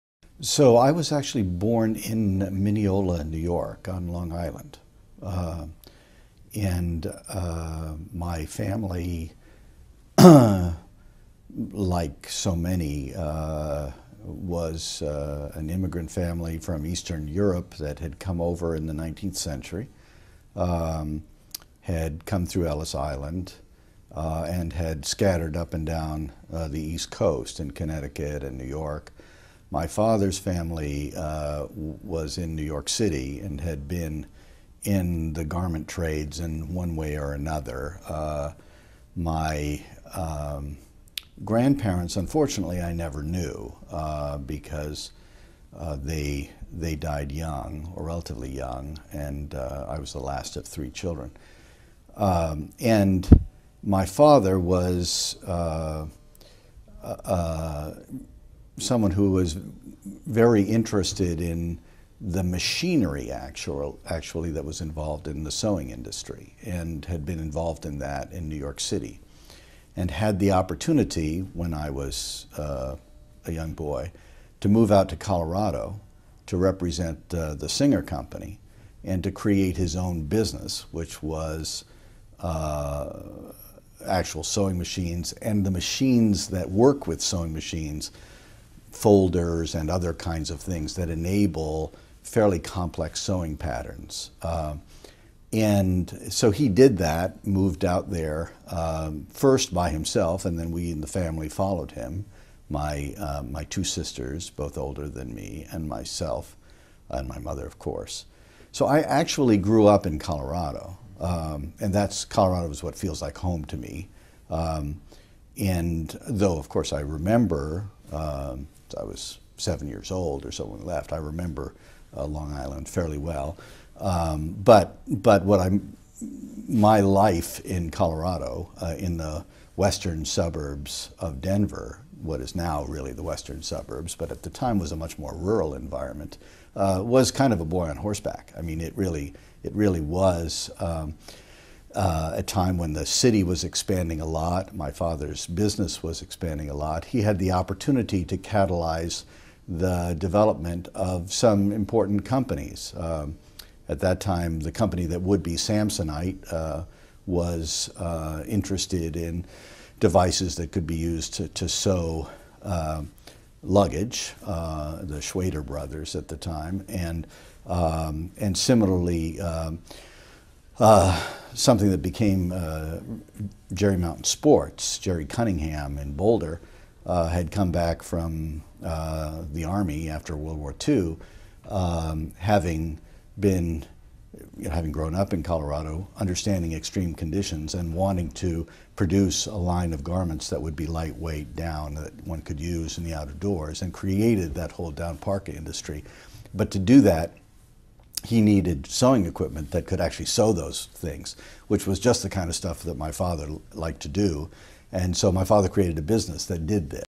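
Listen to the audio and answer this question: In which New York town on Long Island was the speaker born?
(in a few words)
Mineola.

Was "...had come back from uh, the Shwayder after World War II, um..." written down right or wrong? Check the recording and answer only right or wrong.
wrong.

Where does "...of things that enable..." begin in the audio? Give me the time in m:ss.
1:30.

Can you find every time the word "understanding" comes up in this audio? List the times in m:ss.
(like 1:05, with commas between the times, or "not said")
3:06.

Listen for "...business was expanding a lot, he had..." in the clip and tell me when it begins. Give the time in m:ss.
2:25.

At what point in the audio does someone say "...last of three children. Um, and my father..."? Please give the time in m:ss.
0:50.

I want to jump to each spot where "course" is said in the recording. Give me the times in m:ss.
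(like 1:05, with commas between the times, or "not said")
1:47, 1:56.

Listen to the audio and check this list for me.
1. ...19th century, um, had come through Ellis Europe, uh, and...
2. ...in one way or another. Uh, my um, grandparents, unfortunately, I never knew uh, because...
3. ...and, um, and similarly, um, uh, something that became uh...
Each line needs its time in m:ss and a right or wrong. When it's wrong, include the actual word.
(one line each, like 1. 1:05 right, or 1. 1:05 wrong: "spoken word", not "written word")
1. 0:18 wrong: "Island", not "Europe"
2. 0:36 right
3. 2:46 right.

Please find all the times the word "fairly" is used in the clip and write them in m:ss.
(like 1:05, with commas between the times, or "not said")
1:32, 2:02.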